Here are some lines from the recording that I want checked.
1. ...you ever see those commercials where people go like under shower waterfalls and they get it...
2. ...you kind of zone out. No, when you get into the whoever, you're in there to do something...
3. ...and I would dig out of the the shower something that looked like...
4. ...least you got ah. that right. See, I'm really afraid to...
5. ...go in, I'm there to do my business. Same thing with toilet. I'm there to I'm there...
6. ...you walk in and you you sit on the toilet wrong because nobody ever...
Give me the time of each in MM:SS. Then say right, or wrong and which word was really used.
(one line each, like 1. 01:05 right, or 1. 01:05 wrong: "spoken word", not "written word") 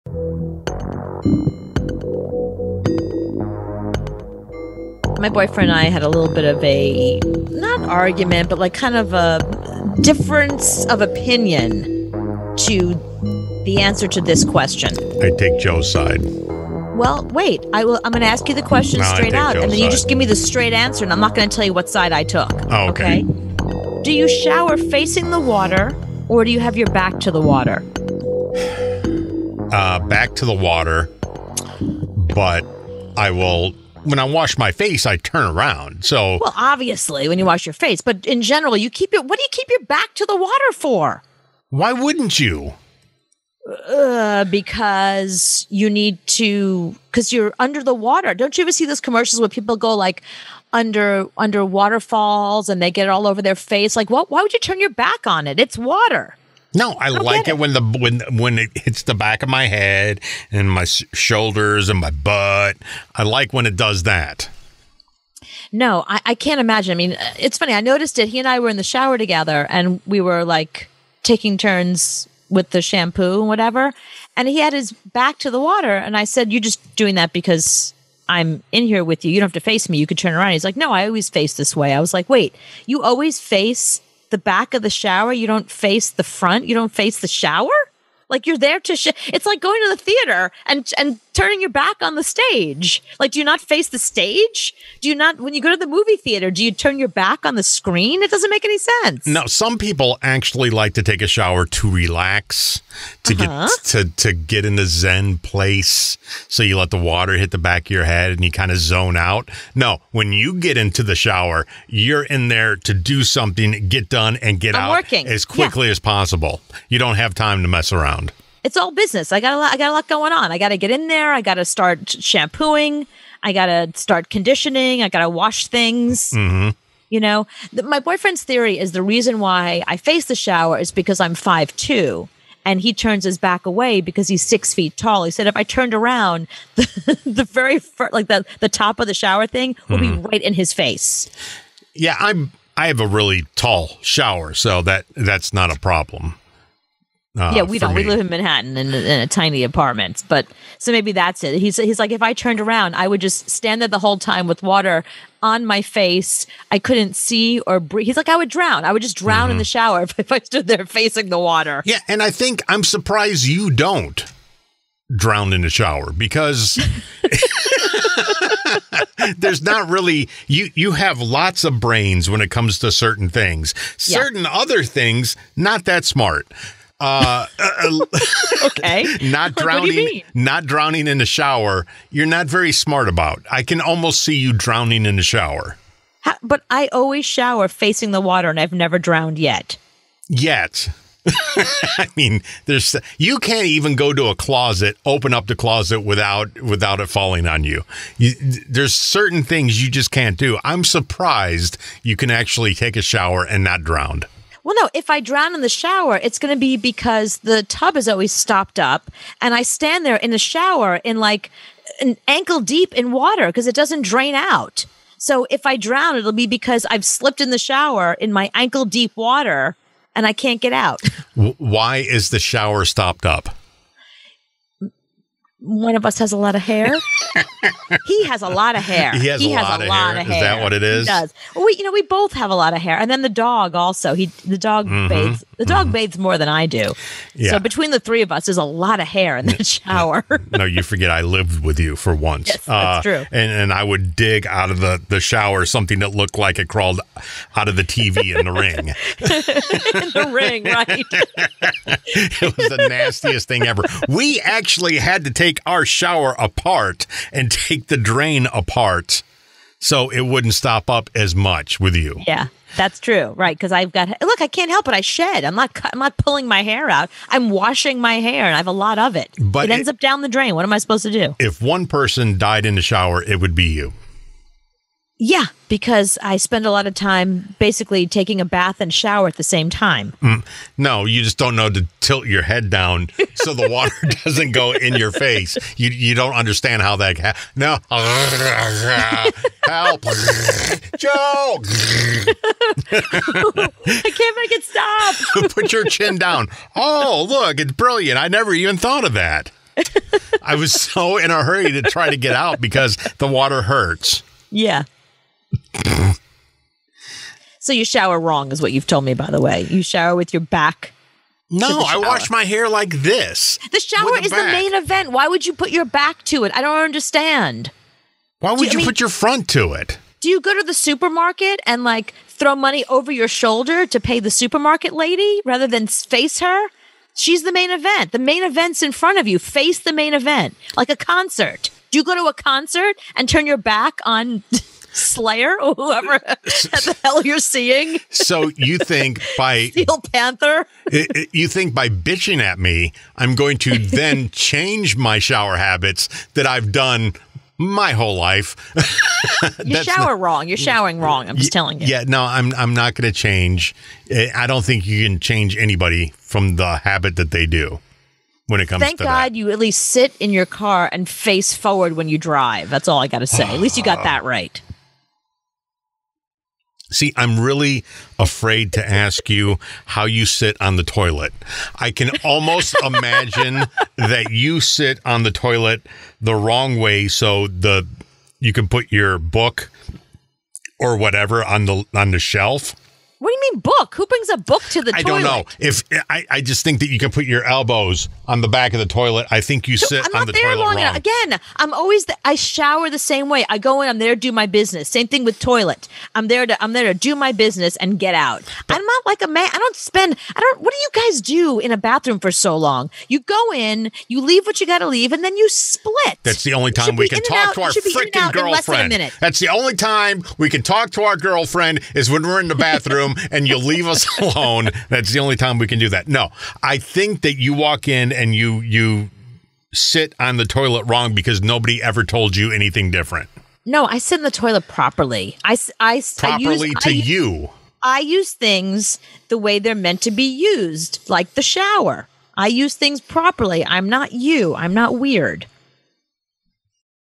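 1. 00:48 wrong: "under", not "shower"
2. 01:48 wrong: "shower", not "whoever"
3. 04:03 right
4. 06:03 right
5. 06:33 right
6. 06:57 right.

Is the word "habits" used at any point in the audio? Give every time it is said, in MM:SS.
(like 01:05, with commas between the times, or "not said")
05:45, 05:56.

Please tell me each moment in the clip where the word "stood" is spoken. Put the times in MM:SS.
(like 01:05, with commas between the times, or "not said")
02:40.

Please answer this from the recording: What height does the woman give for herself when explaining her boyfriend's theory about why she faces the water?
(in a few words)
5'2".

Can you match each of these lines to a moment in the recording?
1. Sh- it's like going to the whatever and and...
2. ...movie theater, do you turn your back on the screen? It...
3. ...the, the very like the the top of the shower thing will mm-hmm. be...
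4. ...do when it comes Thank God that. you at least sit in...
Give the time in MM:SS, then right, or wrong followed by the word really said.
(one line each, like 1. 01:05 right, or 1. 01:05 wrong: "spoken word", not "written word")
1. 01:28 wrong: "theater", not "whatever"
2. 01:35 right
3. 02:16 right
4. 05:57 right.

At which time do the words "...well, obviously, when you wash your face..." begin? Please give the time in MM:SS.
00:36.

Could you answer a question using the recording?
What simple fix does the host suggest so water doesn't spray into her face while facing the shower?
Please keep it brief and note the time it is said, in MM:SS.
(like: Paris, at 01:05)
Put your chin down, at 04:55.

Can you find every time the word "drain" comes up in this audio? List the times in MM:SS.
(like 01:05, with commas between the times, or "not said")
03:34, 04:17, 04:30.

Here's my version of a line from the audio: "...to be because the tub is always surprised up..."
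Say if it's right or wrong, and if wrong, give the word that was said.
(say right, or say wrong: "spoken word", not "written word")
wrong: "stopped", not "surprised".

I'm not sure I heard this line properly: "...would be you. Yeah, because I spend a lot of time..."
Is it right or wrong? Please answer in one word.
right.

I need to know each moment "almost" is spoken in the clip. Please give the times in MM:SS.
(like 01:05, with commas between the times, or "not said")
03:03, 06:12.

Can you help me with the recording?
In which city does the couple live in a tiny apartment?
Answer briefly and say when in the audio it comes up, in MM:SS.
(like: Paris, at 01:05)
Manhattan, at 02:28.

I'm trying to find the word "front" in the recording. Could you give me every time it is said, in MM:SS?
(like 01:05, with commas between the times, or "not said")
01:26, 05:19, 05:28.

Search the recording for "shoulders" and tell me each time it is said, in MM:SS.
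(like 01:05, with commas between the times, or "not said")
01:00, 05:23.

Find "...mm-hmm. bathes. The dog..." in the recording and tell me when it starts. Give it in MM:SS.
03:54.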